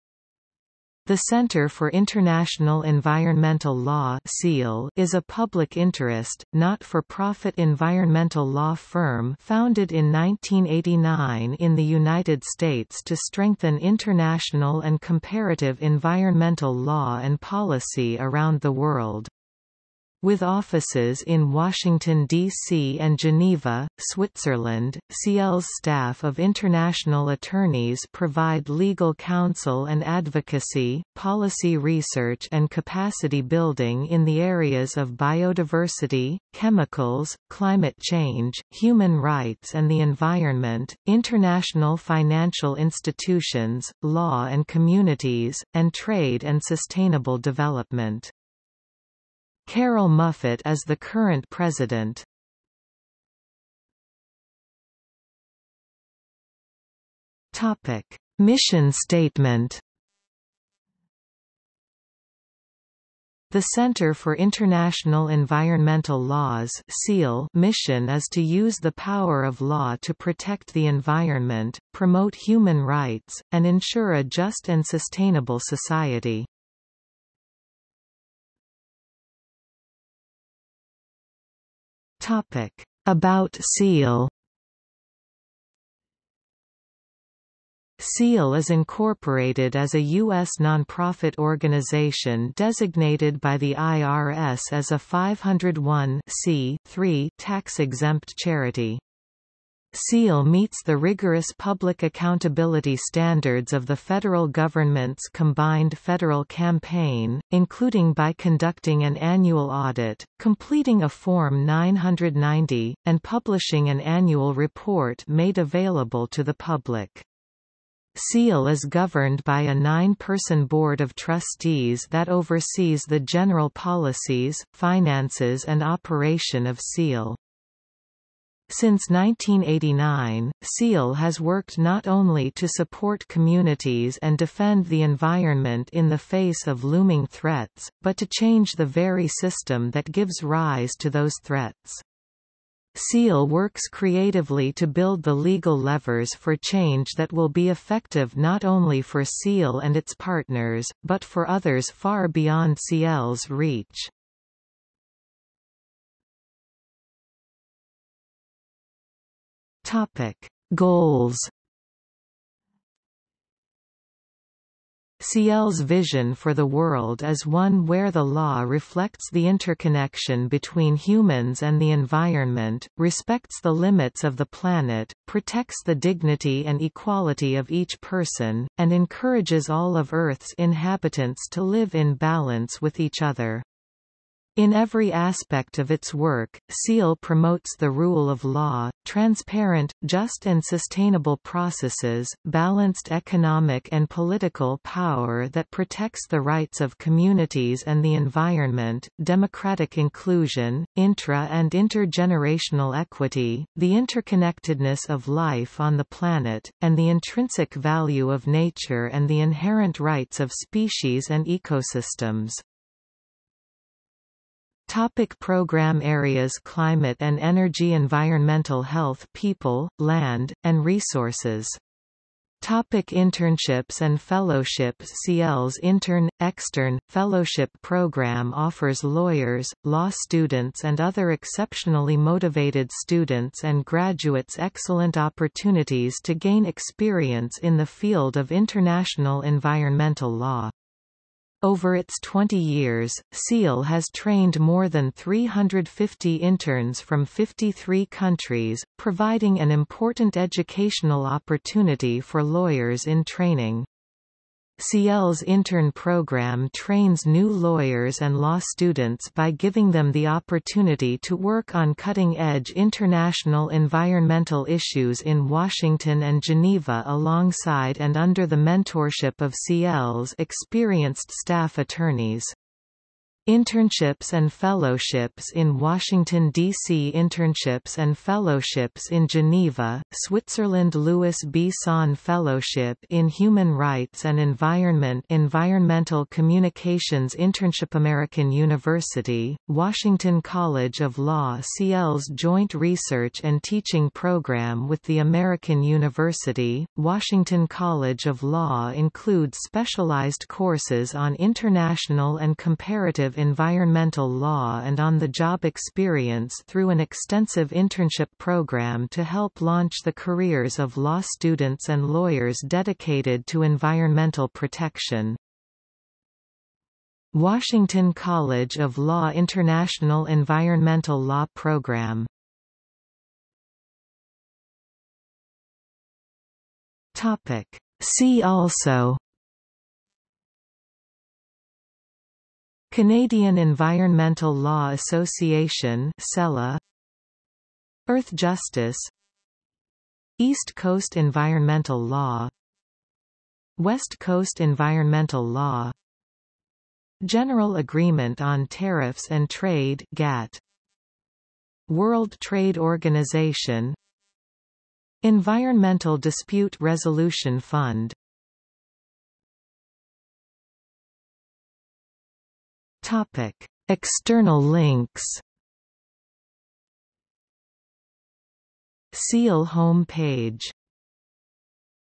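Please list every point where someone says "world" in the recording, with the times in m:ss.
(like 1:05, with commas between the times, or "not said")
0:18, 2:46, 5:51.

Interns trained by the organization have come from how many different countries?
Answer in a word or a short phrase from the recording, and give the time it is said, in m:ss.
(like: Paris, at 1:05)
53, at 4:07.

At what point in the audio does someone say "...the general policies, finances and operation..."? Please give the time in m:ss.
2:03.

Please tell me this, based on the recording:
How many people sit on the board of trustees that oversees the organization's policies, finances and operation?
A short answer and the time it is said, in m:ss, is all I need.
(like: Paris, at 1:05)
9, at 1:59.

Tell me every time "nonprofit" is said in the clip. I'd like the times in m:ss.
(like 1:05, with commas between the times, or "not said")
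1:30.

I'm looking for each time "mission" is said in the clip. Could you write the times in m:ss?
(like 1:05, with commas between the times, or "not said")
0:58, 1:07.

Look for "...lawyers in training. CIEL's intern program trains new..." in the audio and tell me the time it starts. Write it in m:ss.
4:12.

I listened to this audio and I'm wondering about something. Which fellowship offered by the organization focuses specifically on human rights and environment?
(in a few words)
Louis B. Sohn Fellowship.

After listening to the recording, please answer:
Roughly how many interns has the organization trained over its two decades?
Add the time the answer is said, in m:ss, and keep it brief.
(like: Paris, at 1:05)
more than 350, at 4:04.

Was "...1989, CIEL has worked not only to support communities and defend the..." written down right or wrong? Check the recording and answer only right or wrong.
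right.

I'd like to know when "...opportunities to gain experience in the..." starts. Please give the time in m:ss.
3:55.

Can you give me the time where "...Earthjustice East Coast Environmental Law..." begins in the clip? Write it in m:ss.
5:38.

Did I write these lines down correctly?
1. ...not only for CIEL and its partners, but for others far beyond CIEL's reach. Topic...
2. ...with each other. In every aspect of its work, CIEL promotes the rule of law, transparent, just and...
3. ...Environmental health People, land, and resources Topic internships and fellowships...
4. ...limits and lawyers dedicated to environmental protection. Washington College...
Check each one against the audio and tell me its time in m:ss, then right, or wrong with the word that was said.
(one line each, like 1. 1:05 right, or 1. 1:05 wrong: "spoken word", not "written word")
1. 2:28 right
2. 3:02 right
3. 3:37 right
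4. 5:11 wrong: "students", not "limits".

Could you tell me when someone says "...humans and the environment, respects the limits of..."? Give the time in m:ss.
2:50.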